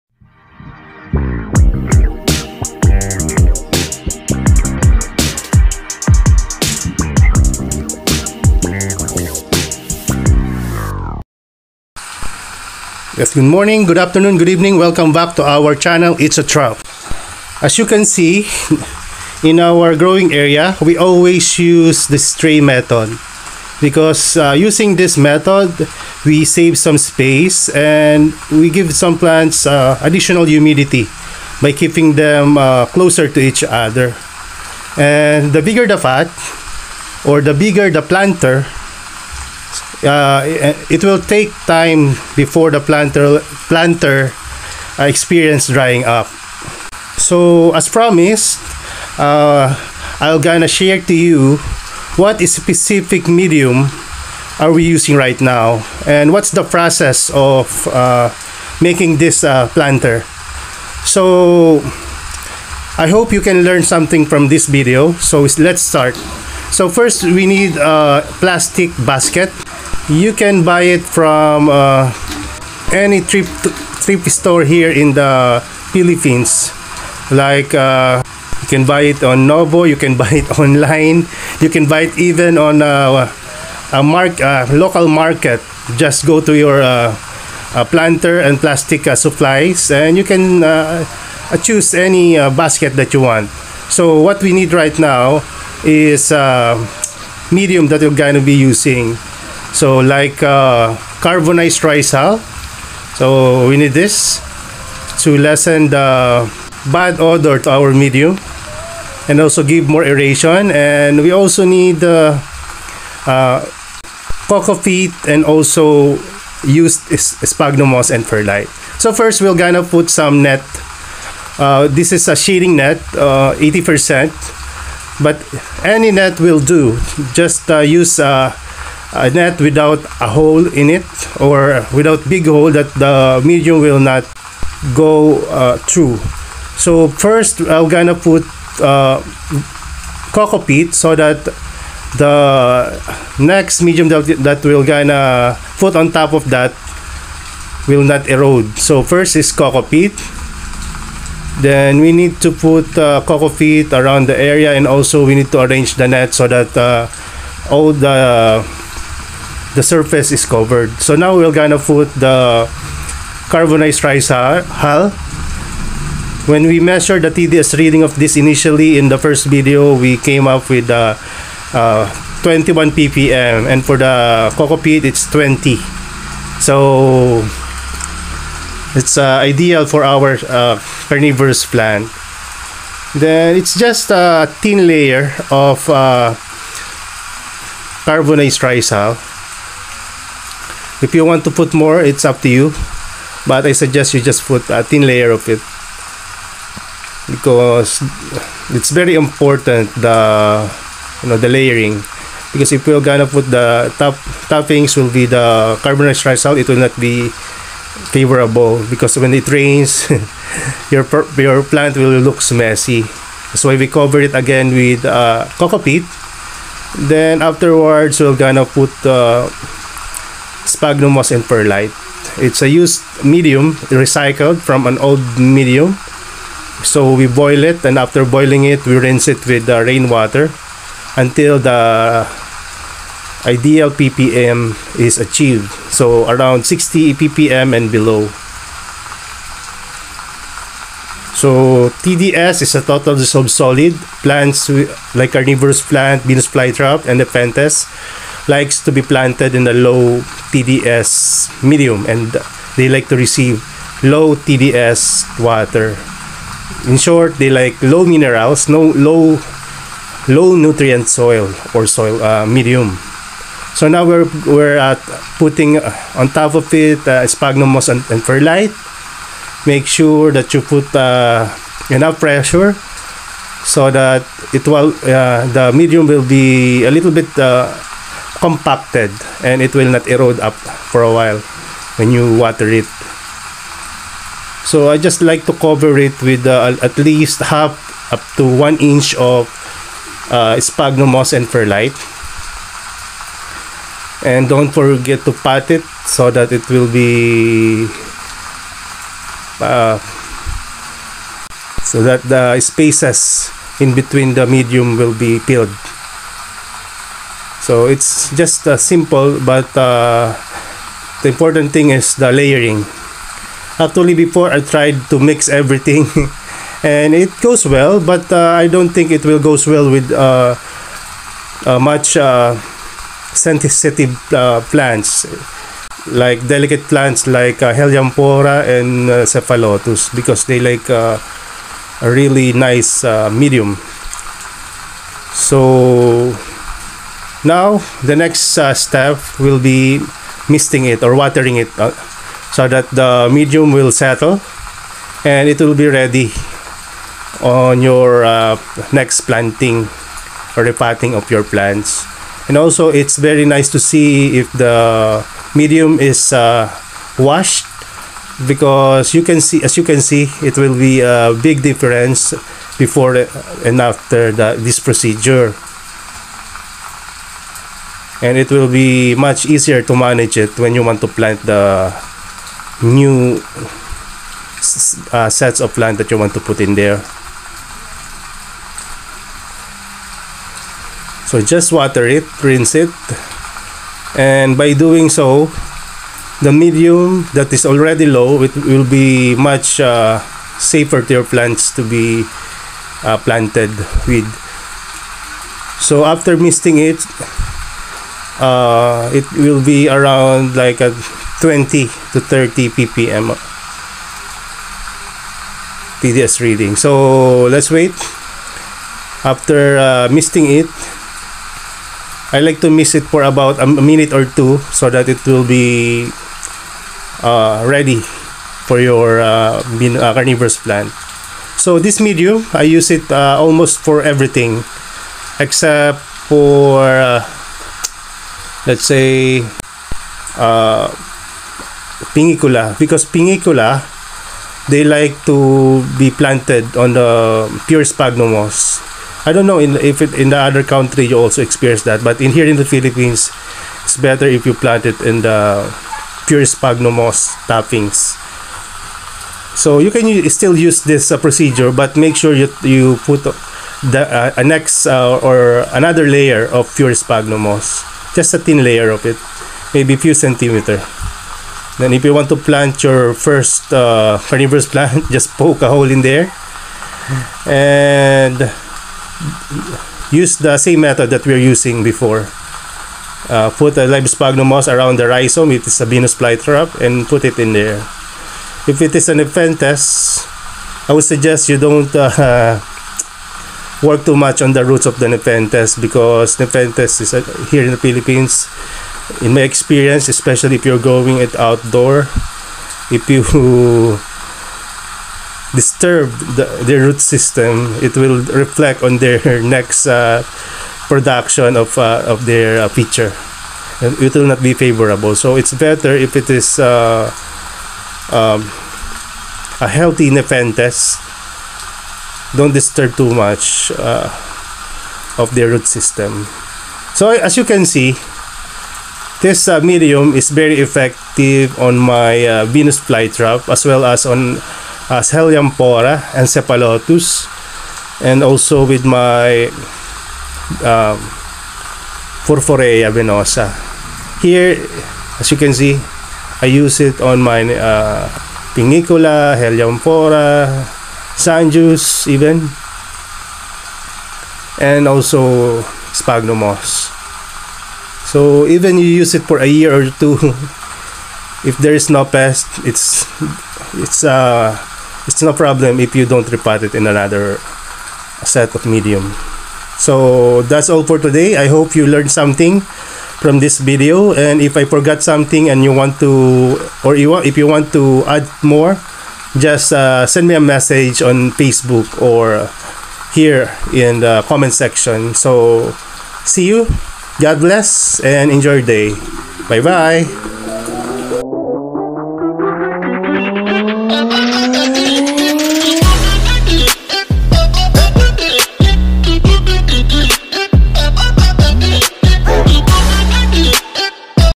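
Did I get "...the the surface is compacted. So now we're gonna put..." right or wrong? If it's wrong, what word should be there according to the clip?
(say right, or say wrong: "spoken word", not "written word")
wrong: "covered", not "compacted".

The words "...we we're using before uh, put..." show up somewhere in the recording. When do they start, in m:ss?
7:51.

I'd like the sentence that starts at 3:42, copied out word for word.
It's a used medium, recycled from an old medium.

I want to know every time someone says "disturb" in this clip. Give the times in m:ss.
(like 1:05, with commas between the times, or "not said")
8:15, 8:32.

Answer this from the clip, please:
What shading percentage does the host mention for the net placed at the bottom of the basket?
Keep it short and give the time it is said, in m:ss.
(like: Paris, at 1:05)
80%, at 2:03.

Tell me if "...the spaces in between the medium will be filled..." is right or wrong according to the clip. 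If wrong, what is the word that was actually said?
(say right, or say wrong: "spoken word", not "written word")
right.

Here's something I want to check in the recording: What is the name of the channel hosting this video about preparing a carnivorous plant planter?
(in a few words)
It's a Trap.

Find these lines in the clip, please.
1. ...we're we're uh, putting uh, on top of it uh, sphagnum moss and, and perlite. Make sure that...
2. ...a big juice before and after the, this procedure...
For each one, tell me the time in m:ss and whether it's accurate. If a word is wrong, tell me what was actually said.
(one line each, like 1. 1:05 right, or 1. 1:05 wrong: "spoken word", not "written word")
1. 4:24 right
2. 6:01 wrong: "difference", not "juice".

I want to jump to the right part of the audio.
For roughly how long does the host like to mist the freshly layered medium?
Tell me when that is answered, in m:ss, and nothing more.
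6:53.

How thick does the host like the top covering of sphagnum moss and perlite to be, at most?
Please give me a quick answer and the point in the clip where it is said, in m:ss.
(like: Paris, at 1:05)
one inch, at 4:48.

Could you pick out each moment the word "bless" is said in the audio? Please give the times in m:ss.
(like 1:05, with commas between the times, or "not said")
9:37.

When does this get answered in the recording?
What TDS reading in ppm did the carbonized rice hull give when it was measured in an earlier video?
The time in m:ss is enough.
2:52.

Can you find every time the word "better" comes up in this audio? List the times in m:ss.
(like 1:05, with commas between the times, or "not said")
7:23, 8:25.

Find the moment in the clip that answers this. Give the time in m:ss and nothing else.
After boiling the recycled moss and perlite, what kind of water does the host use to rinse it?
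3:49.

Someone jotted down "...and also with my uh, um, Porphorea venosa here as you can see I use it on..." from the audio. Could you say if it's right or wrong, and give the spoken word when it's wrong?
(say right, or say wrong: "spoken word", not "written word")
right.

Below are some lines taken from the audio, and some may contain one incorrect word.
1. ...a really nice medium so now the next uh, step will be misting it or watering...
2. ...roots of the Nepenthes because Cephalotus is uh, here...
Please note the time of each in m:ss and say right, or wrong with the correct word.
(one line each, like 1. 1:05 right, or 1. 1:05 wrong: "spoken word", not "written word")
1. 5:30 right
2. 8:04 wrong: "Nepenthes", not "Cephalotus".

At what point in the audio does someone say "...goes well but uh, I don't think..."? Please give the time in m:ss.
5:17.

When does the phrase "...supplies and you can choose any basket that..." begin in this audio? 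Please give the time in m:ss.
1:29.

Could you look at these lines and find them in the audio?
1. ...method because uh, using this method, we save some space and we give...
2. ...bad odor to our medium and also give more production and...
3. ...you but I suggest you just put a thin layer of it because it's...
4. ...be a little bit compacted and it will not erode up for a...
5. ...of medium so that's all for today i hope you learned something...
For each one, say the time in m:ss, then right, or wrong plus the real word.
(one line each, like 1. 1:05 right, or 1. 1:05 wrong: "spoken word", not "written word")
1. 0:22 right
2. 1:46 wrong: "aeration", not "production"
3. 3:12 right
4. 4:36 right
5. 9:18 right.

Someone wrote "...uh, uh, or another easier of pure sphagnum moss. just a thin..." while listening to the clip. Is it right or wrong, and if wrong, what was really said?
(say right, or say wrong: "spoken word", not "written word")
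wrong: "layer", not "easier".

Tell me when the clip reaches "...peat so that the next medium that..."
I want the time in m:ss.
2:20.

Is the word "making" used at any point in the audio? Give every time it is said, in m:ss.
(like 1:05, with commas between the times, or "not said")
0:58.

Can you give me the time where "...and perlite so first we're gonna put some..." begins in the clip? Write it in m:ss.
1:58.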